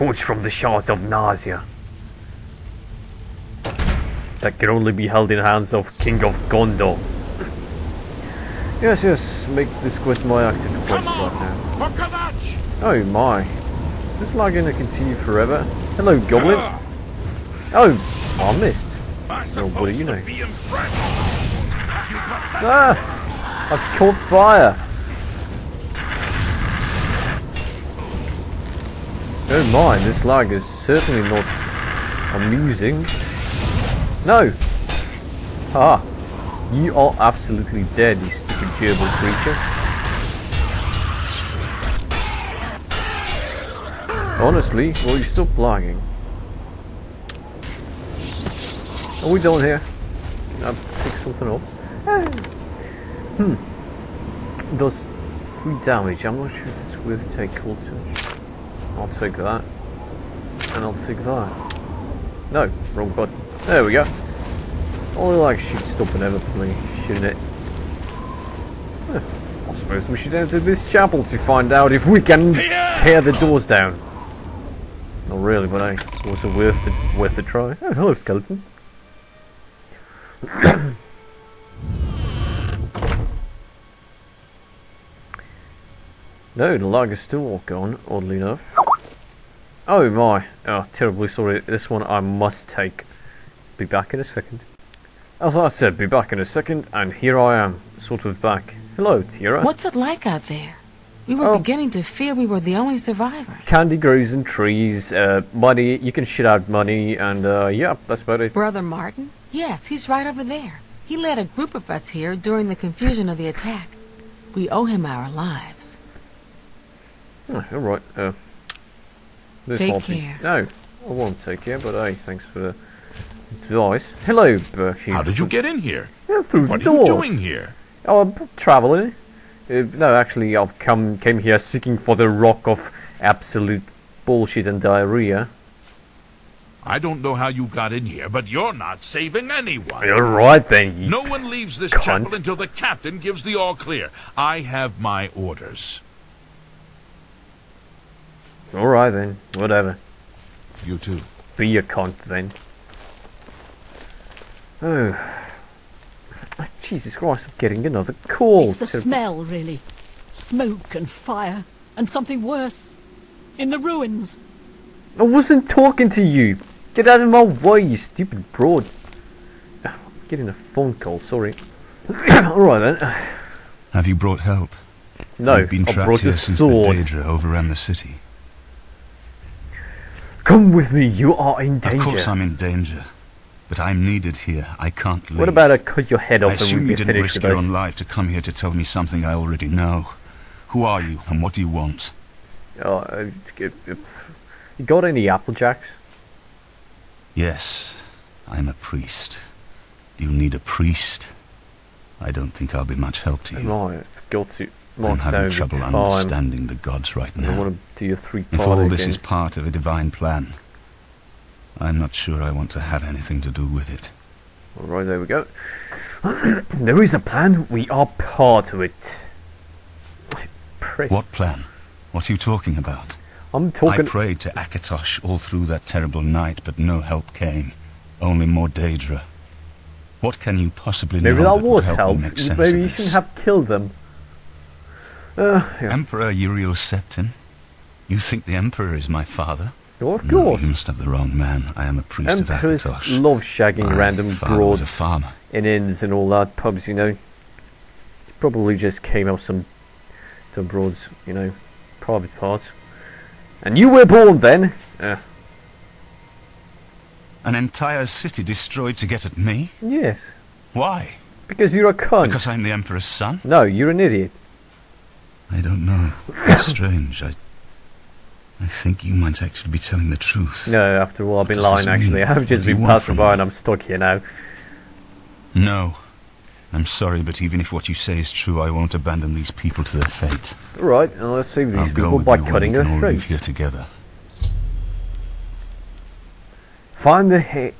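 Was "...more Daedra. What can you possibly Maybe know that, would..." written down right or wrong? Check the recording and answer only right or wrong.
right.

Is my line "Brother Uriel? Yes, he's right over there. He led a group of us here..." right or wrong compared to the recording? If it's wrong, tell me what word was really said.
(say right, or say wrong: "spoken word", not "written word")
wrong: "Martin", not "Uriel".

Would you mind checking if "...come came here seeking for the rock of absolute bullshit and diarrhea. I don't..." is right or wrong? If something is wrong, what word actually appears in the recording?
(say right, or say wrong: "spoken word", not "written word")
right.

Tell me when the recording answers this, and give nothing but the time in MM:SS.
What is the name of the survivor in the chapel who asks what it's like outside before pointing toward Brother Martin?
01:39.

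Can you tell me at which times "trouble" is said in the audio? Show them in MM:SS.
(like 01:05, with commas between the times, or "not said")
03:25.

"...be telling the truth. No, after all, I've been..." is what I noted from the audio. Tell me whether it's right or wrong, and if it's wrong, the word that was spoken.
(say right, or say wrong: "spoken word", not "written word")
right.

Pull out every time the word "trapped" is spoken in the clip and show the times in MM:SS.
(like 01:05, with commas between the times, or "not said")
02:55.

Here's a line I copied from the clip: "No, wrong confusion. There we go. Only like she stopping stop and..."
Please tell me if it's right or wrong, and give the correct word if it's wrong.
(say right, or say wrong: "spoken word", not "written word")
wrong: "button", not "confusion".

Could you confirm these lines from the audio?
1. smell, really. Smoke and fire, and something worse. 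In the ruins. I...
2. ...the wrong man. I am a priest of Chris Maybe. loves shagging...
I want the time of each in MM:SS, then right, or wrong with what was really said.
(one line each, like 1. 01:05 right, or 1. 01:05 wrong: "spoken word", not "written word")
1. 02:38 right
2. 04:00 wrong: "Akatosh", not "Maybe".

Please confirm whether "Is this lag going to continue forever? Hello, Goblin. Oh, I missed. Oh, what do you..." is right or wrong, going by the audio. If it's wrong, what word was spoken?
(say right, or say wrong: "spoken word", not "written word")
right.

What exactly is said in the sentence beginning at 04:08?
Probably just came out some, some broads, you know, private parts.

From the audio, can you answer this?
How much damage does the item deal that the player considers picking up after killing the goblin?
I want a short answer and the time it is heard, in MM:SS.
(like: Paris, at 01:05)
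3, at 00:55.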